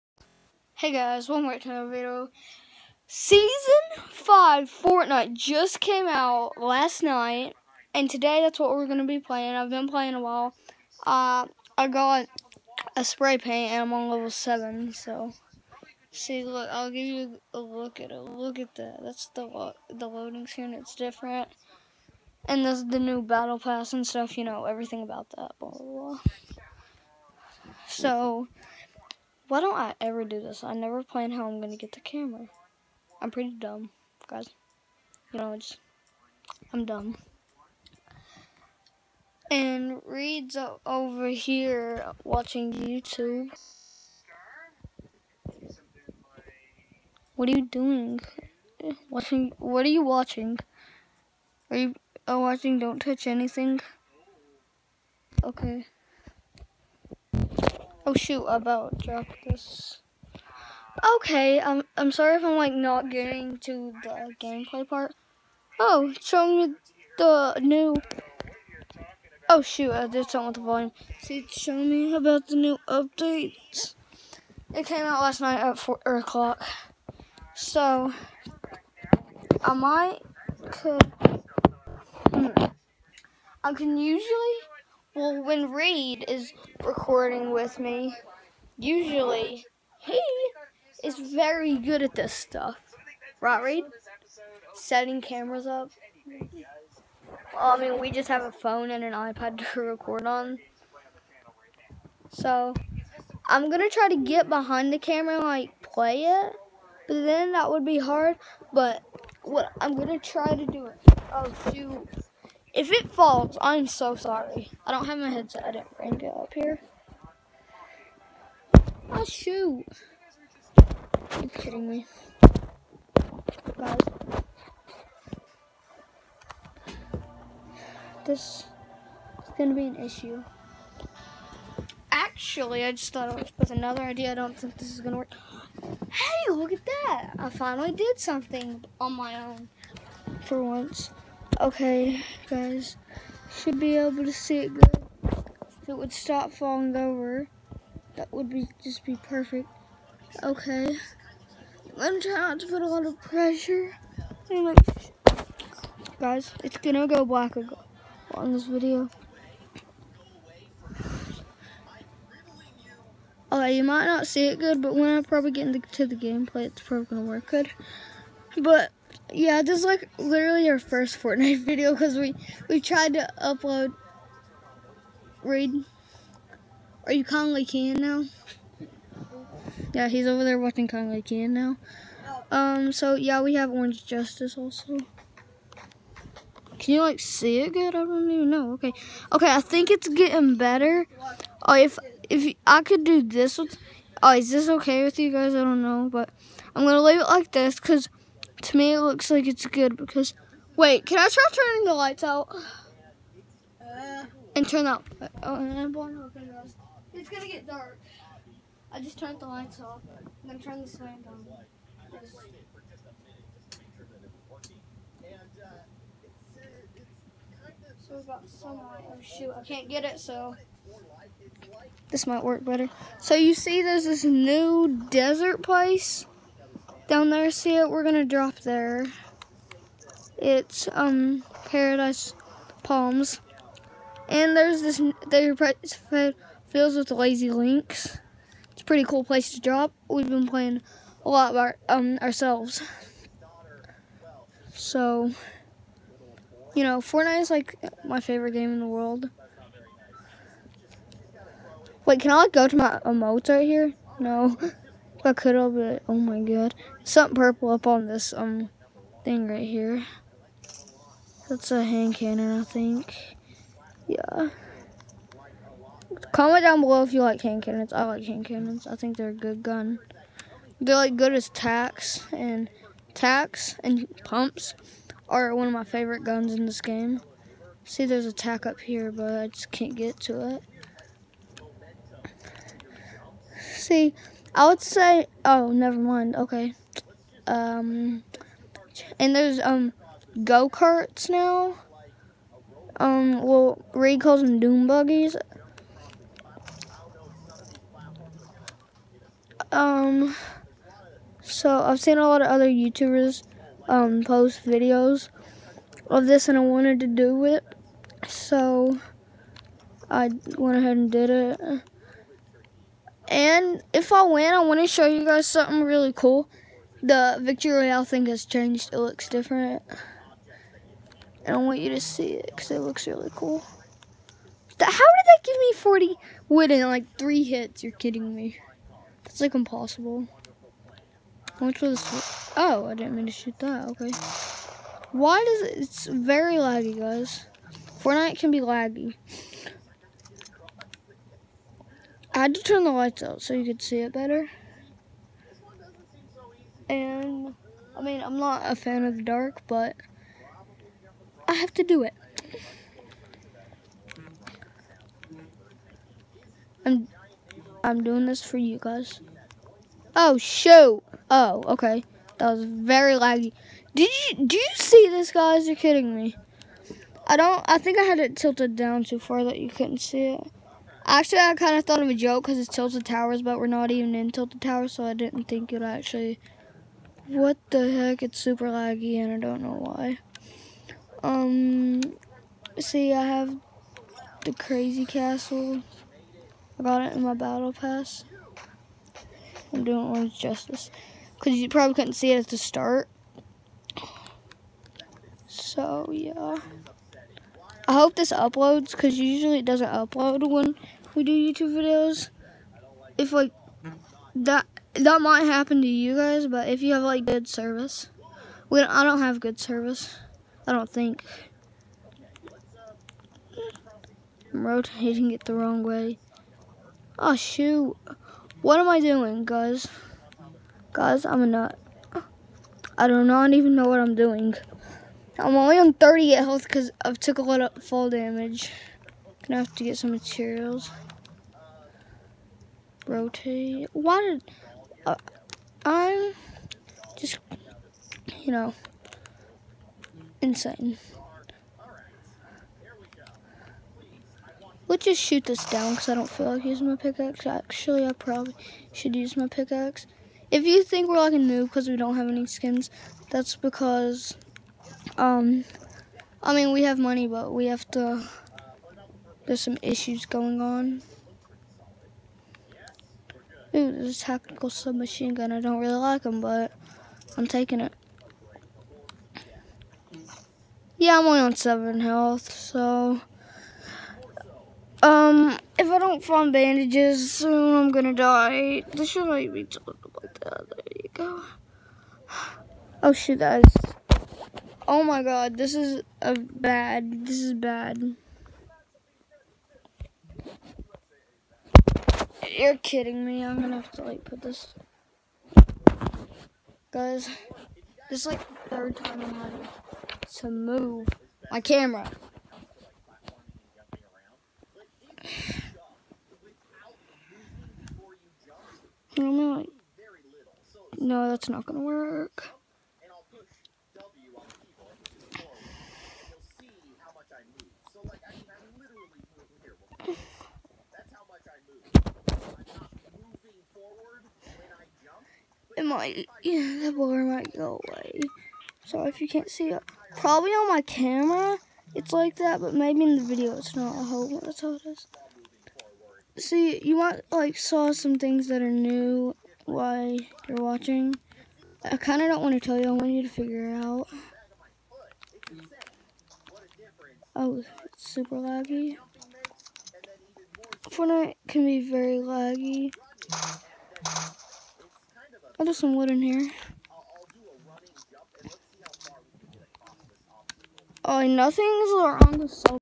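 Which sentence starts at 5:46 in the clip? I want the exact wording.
And, I mean, I'm not a fan of the dark, but I have to do it.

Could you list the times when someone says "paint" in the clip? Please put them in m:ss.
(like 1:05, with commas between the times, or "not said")
0:13.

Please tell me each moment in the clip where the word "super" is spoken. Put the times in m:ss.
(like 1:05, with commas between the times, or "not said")
6:18, 9:08.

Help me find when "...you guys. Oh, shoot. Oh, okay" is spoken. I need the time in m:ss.
5:58.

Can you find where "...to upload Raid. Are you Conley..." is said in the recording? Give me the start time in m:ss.
2:53.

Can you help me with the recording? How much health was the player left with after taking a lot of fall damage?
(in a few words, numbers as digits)
38.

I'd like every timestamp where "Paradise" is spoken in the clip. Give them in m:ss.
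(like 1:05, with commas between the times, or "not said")
3:51.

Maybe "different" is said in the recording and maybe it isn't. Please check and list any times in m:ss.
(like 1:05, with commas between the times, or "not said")
0:20, 5:19.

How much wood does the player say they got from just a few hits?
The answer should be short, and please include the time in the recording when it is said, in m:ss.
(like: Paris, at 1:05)
40, at 5:25.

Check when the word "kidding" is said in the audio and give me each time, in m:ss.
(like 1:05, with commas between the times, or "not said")
2:01, 5:27, 6:05, 8:12.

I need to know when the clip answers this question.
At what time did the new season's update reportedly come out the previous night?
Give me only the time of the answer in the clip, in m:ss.
1:15.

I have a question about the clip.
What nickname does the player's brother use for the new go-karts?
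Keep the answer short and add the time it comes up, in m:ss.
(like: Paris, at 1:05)
Doom buggies, at 4:54.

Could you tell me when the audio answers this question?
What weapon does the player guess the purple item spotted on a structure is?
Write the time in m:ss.
4:21.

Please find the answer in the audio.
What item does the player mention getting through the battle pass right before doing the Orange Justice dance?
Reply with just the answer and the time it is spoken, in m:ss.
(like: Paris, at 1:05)
Crazy Castle, at 6:24.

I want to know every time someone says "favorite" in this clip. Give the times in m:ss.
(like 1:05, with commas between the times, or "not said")
4:08, 4:35.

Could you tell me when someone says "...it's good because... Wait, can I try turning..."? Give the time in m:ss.
3:19.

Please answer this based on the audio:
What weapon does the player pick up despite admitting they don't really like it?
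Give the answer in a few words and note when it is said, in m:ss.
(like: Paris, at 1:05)
Tactical submachine gun, at 7:44.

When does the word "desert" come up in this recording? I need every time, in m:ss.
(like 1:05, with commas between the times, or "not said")
3:45.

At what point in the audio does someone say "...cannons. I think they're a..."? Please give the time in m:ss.
4:28.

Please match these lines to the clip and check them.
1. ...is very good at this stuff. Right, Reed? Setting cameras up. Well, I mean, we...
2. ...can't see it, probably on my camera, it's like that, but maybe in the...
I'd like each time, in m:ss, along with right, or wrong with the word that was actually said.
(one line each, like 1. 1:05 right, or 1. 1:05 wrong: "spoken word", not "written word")
1. 1:31 right
2. 8:49 right.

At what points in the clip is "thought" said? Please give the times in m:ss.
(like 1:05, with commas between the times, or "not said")
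2:13, 6:11.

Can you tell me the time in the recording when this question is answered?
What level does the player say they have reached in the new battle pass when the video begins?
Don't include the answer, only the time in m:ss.
0:14.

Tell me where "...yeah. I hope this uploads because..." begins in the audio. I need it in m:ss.
6:36.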